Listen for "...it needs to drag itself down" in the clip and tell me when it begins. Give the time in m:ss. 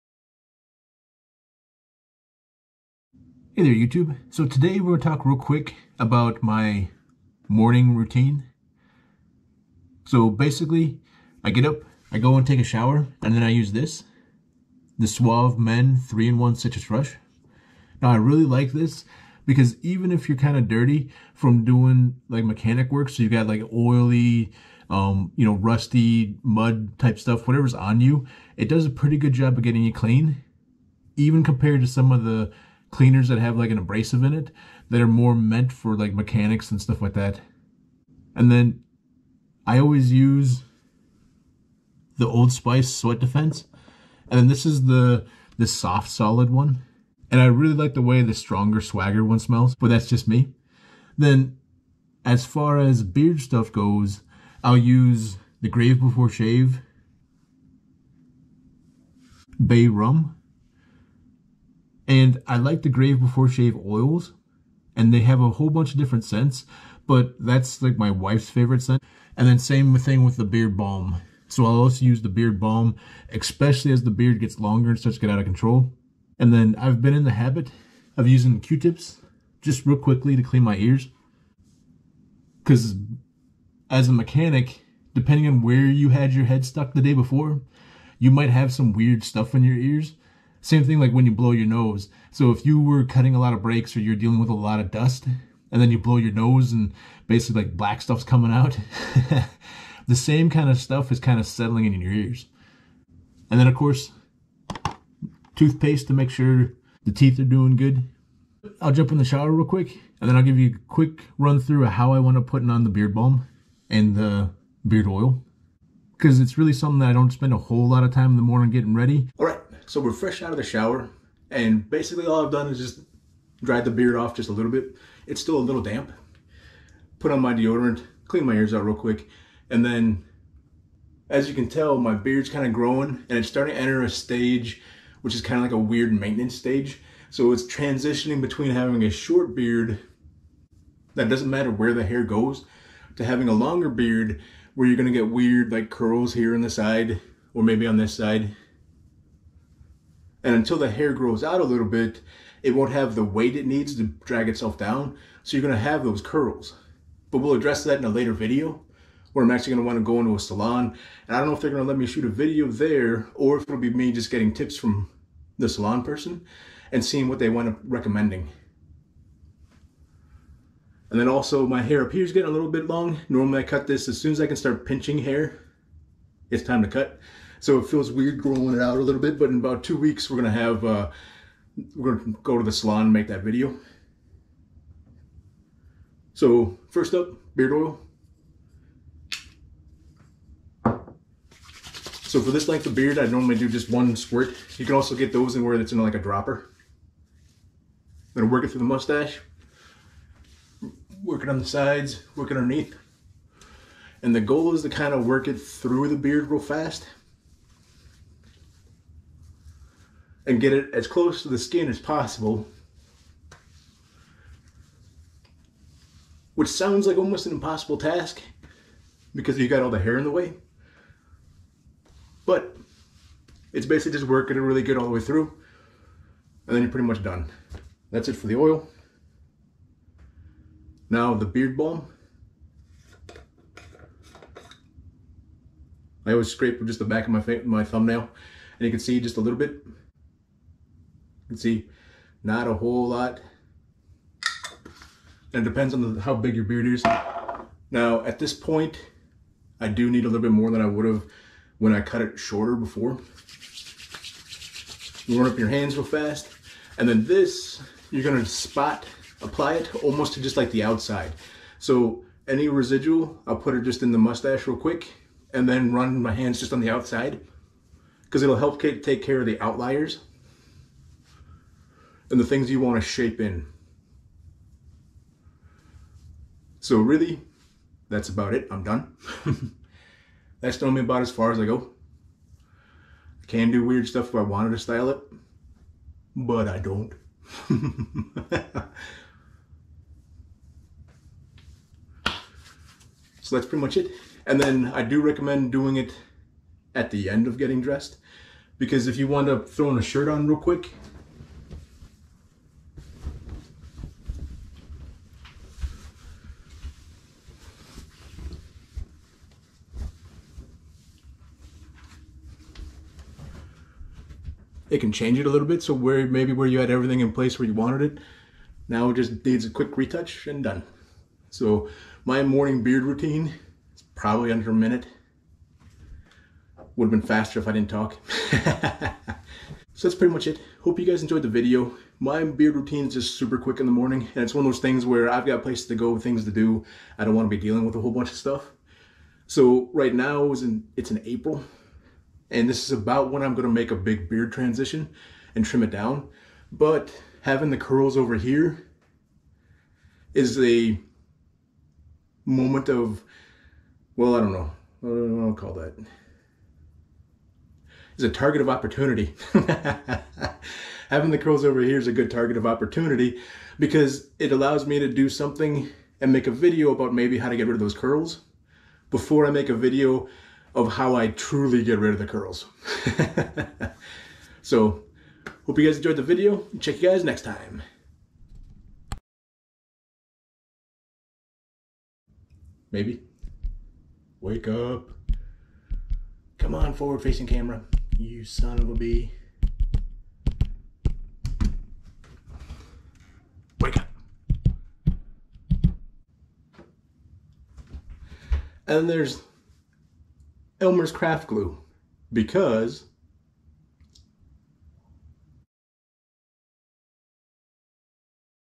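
2:33.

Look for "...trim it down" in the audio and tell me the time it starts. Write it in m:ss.
5:45.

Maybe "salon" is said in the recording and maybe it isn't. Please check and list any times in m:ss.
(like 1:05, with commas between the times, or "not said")
2:40, 2:45, 3:02.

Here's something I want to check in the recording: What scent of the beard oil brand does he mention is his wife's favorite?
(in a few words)
Bay Rum.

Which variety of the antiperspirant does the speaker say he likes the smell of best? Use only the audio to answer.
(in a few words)
Stronger Swagger.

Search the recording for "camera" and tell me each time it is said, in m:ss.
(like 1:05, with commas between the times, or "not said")
6:27.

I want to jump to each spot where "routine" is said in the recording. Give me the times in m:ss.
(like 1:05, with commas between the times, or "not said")
0:07, 5:23, 5:32.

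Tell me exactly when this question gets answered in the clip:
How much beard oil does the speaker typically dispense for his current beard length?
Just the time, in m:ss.
3:13.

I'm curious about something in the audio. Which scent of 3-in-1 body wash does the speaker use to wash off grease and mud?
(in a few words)
Citrus Rush.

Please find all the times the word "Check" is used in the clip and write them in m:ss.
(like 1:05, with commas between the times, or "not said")
6:16.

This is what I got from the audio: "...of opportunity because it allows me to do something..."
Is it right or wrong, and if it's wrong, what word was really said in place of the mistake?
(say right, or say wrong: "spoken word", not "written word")
right.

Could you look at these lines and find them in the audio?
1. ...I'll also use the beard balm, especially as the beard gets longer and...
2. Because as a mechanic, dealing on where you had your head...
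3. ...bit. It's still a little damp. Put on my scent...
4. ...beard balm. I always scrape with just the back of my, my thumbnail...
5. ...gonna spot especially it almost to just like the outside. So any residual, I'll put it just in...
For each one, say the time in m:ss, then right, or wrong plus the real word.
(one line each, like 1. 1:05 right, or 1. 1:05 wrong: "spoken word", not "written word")
1. 1:11 right
2. 1:22 wrong: "depending", not "dealing"
3. 2:04 wrong: "deodorant", not "scent"
4. 3:51 right
5. 4:18 wrong: "apply", not "especially".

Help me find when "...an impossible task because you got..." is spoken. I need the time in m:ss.
3:37.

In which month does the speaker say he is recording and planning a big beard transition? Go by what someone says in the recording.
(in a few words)
April.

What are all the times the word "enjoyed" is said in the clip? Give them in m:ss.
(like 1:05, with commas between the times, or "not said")
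5:31, 6:15.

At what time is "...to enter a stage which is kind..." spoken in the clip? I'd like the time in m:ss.
2:13.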